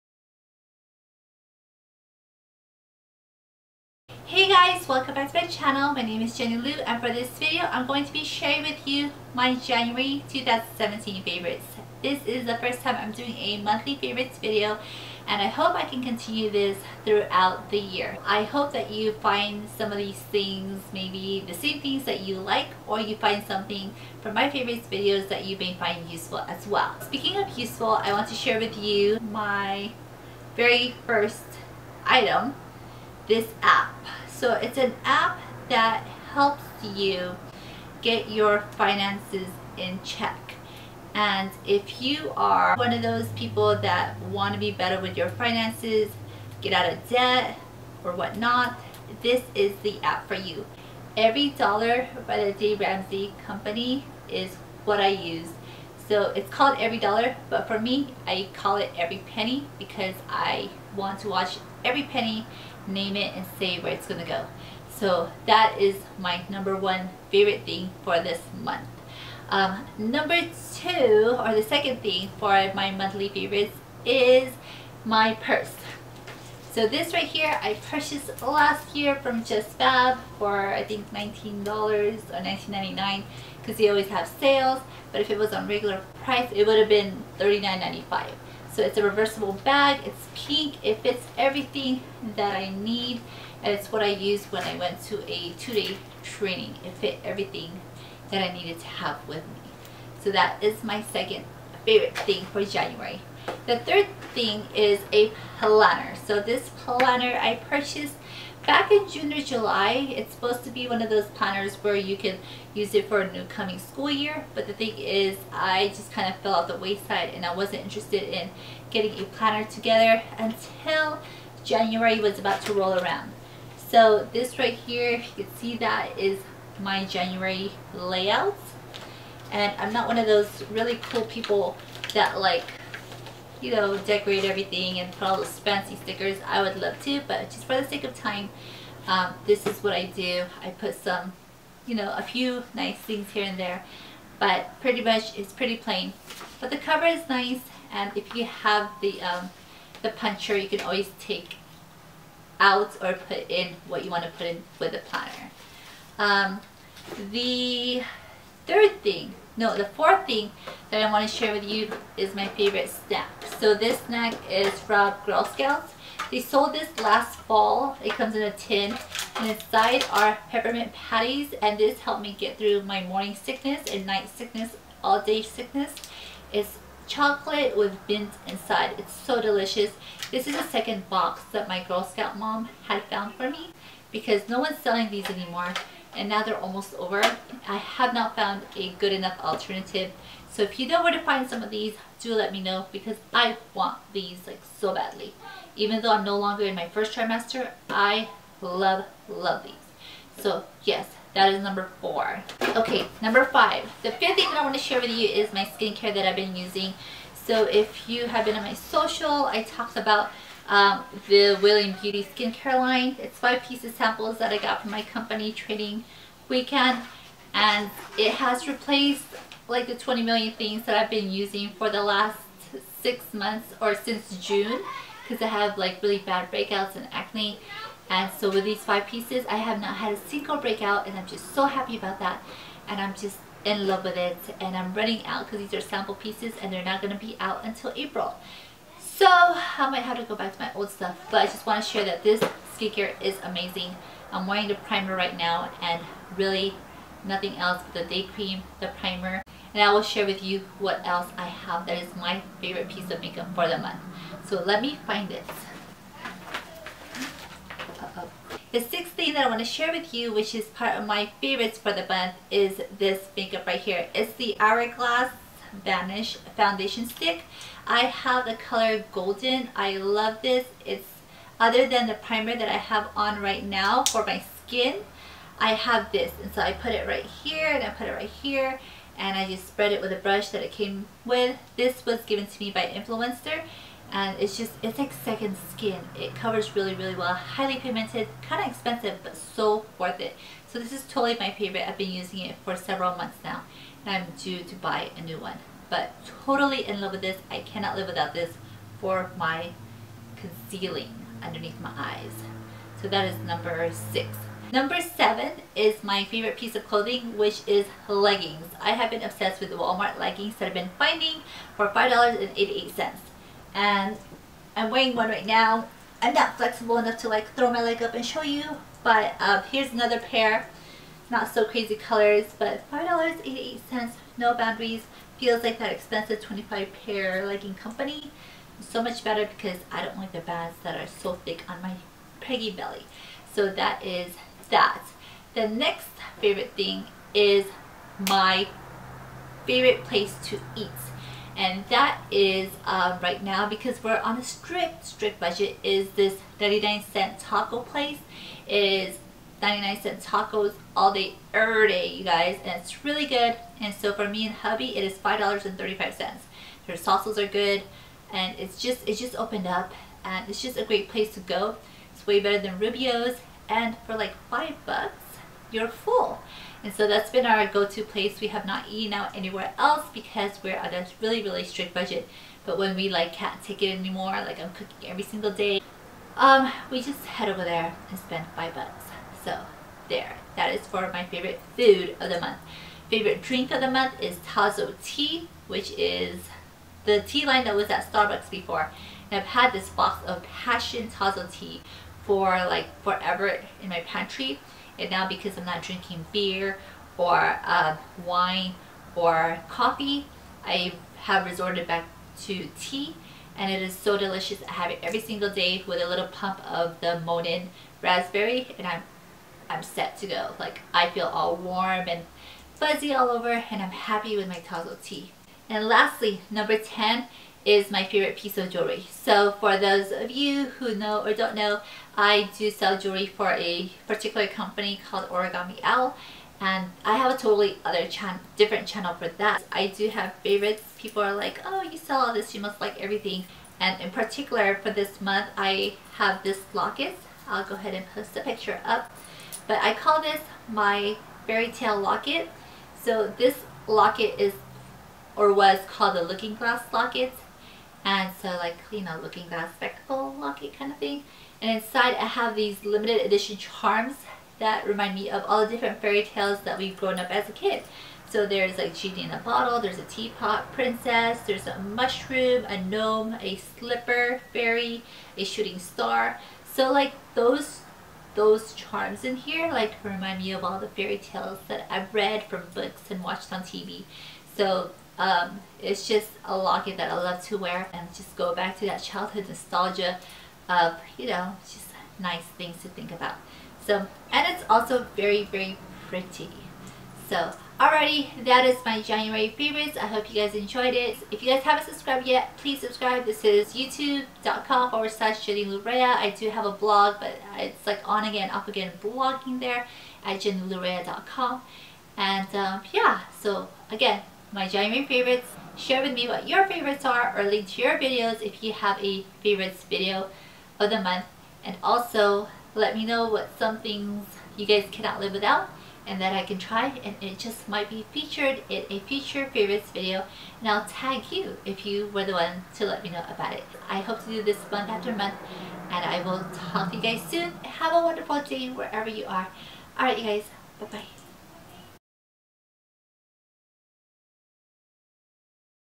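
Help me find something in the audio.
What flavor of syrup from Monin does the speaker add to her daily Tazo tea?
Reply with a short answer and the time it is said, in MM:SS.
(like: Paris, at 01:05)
Raspberry, at 06:48.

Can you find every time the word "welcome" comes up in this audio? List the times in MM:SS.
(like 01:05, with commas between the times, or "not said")
00:04.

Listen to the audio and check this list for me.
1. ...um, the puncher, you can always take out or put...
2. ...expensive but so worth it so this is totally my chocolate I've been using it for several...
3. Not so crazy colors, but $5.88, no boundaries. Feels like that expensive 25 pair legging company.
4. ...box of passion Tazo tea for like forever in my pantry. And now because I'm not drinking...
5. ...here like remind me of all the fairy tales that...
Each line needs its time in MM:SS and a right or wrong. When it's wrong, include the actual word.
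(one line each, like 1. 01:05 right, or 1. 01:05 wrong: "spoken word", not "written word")
1. 02:29 right
2. 04:48 wrong: "favorite", not "chocolate"
3. 05:21 right
4. 06:29 right
5. 07:49 right.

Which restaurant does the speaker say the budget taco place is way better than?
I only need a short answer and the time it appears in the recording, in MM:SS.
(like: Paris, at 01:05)
Rubio's, at 06:02.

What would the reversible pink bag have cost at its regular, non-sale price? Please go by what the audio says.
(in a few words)
$39.95.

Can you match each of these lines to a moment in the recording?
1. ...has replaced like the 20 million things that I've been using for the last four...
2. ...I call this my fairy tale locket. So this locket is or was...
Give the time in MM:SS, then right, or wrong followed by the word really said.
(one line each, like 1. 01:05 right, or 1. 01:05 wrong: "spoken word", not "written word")
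1. 03:38 wrong: "six", not "four"
2. 07:19 right.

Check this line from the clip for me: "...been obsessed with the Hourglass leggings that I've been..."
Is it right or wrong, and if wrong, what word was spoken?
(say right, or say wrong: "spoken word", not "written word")
wrong: "Walmart", not "Hourglass".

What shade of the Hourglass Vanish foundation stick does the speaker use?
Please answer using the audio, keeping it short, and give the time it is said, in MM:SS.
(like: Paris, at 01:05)
Golden, at 04:29.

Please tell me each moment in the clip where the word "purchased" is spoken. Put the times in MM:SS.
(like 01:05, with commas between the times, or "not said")
01:17, 01:47.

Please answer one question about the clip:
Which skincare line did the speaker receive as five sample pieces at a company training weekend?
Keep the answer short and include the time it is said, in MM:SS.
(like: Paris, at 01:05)
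Willing Beauty, at 03:31.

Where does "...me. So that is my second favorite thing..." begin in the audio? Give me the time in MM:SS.
01:39.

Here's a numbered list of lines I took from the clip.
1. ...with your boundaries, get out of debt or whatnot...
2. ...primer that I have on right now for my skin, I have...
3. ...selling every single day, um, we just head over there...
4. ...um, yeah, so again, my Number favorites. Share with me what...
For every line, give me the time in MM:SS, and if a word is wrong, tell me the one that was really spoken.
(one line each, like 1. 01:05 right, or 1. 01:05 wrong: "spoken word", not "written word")
1. 00:44 wrong: "finances", not "boundaries"
2. 04:32 right
3. 06:14 wrong: "cooking", not "selling"
4. 08:22 wrong: "January", not "Number".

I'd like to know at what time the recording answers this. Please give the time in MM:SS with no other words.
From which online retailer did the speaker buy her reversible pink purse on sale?
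01:19.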